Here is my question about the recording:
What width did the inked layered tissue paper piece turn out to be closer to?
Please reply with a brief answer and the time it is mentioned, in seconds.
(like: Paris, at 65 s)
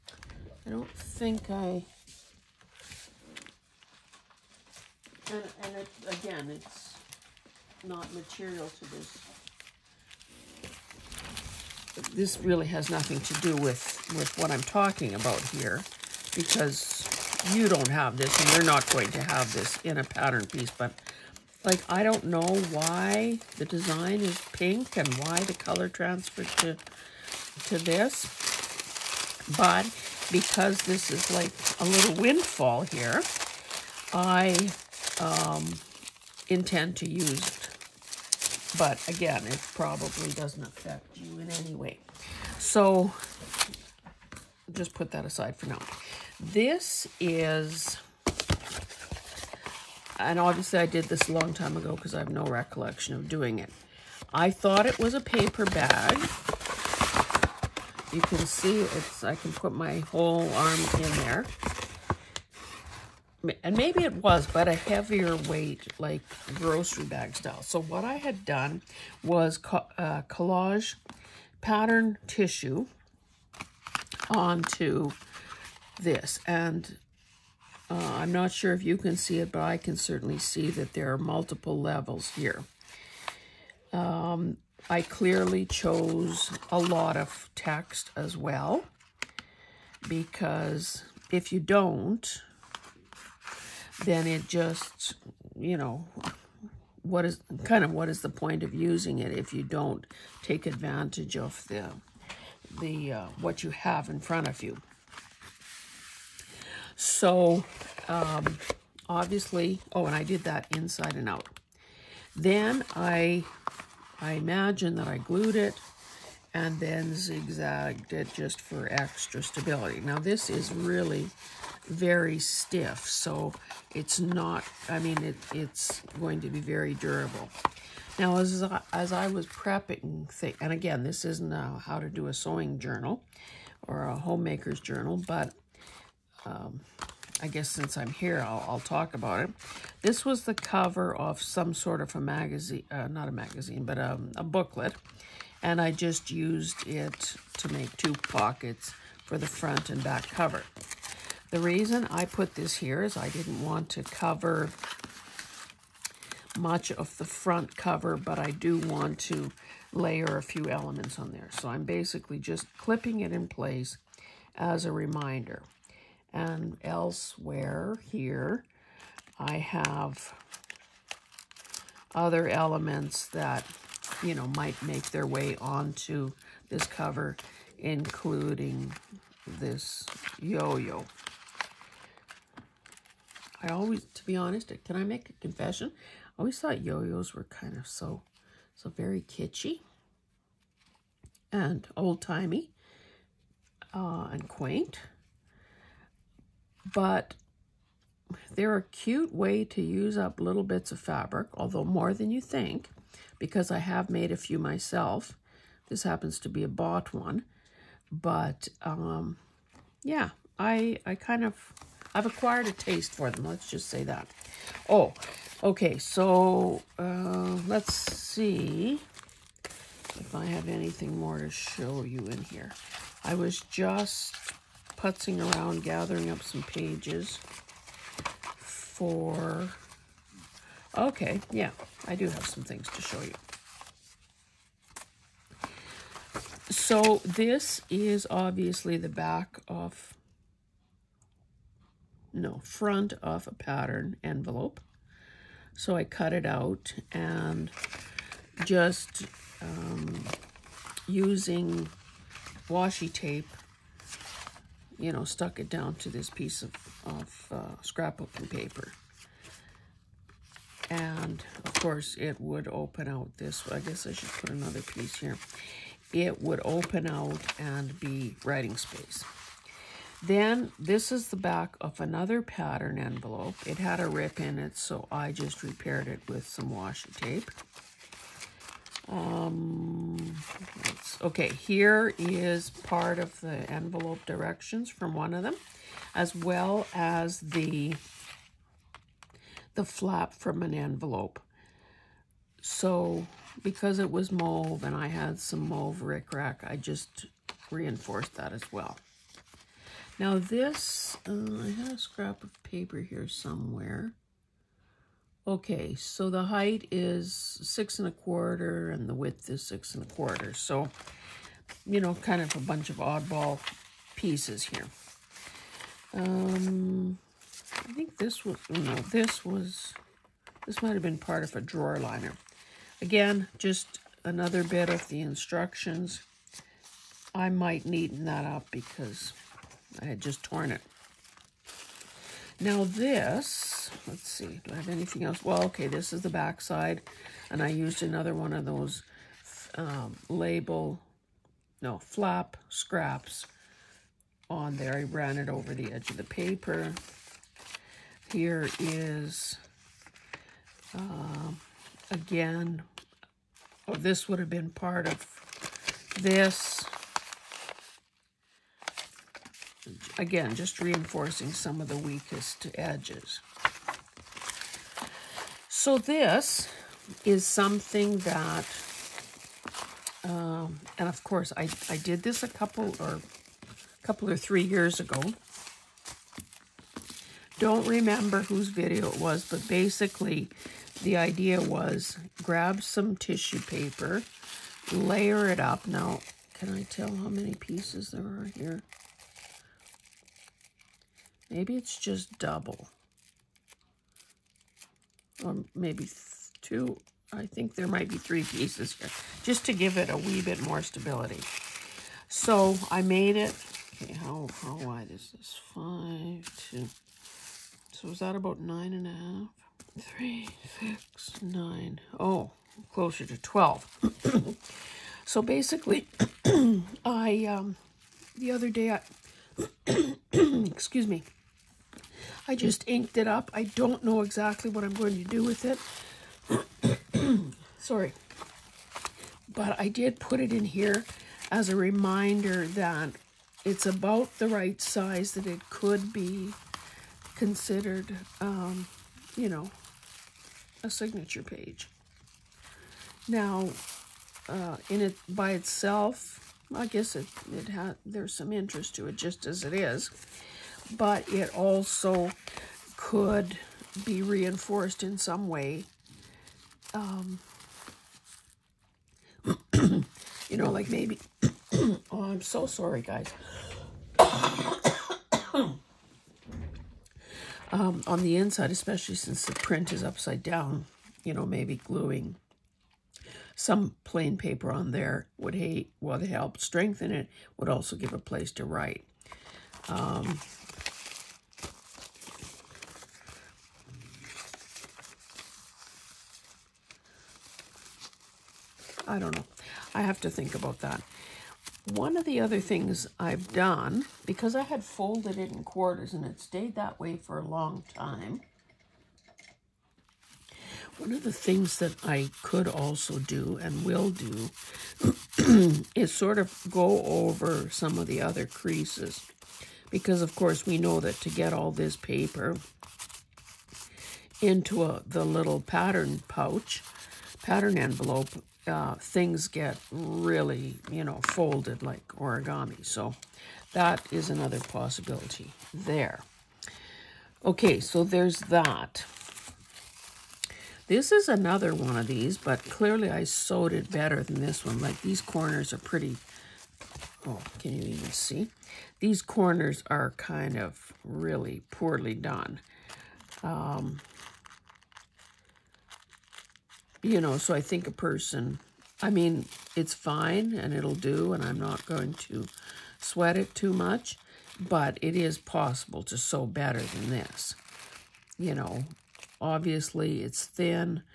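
12, at 413 s.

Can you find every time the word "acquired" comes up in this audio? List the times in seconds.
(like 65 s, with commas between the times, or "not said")
212 s.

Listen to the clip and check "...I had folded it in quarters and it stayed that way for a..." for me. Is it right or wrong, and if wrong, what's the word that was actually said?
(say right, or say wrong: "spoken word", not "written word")
right.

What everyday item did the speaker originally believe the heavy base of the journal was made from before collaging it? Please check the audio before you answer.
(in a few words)
A paper bag.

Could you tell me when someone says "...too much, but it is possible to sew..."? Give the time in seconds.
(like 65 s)
553 s.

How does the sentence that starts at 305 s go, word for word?
Okay, so the height is six and a quarter and the width is six and a quarter.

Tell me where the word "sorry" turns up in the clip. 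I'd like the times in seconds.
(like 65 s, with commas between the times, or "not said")
427 s, 462 s.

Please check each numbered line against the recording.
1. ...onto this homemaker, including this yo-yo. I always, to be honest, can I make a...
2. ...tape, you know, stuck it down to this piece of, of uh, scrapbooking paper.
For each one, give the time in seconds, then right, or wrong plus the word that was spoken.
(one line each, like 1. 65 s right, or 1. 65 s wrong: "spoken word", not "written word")
1. 175 s wrong: "cover", not "homemaker"
2. 253 s right.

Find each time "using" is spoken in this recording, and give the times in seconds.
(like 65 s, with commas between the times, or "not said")
98 s, 251 s.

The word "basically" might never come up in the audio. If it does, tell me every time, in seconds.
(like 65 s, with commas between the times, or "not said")
161 s, 379 s, 415 s.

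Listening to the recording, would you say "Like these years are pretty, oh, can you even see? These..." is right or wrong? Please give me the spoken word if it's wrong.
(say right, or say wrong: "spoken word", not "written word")
wrong: "corners", not "years".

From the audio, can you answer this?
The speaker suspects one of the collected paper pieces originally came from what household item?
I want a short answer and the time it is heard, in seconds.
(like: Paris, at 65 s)
A drawer liner, at 321 s.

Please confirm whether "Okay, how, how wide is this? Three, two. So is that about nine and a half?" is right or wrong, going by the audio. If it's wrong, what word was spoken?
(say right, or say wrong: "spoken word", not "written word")
wrong: "Five", not "Three".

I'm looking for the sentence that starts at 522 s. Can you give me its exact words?
So that is another possibility there.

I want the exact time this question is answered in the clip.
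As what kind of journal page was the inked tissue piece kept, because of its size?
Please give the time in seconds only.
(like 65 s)
440 s.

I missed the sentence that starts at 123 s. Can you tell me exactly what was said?
So it's not, I mean, it, it's going to be very durable.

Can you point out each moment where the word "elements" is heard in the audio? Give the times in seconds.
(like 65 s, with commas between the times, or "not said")
160 s, 172 s.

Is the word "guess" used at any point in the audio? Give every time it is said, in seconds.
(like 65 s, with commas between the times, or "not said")
137 s, 263 s, 446 s.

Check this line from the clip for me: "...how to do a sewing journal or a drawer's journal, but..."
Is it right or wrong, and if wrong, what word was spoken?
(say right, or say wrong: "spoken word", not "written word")
wrong: "homemaker", not "drawer".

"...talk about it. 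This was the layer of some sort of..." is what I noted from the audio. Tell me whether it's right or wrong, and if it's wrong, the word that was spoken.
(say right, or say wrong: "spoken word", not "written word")
wrong: "cover", not "layer".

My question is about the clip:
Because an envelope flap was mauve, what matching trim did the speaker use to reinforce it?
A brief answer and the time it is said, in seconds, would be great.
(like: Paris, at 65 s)
Mauve rickrack, at 295 s.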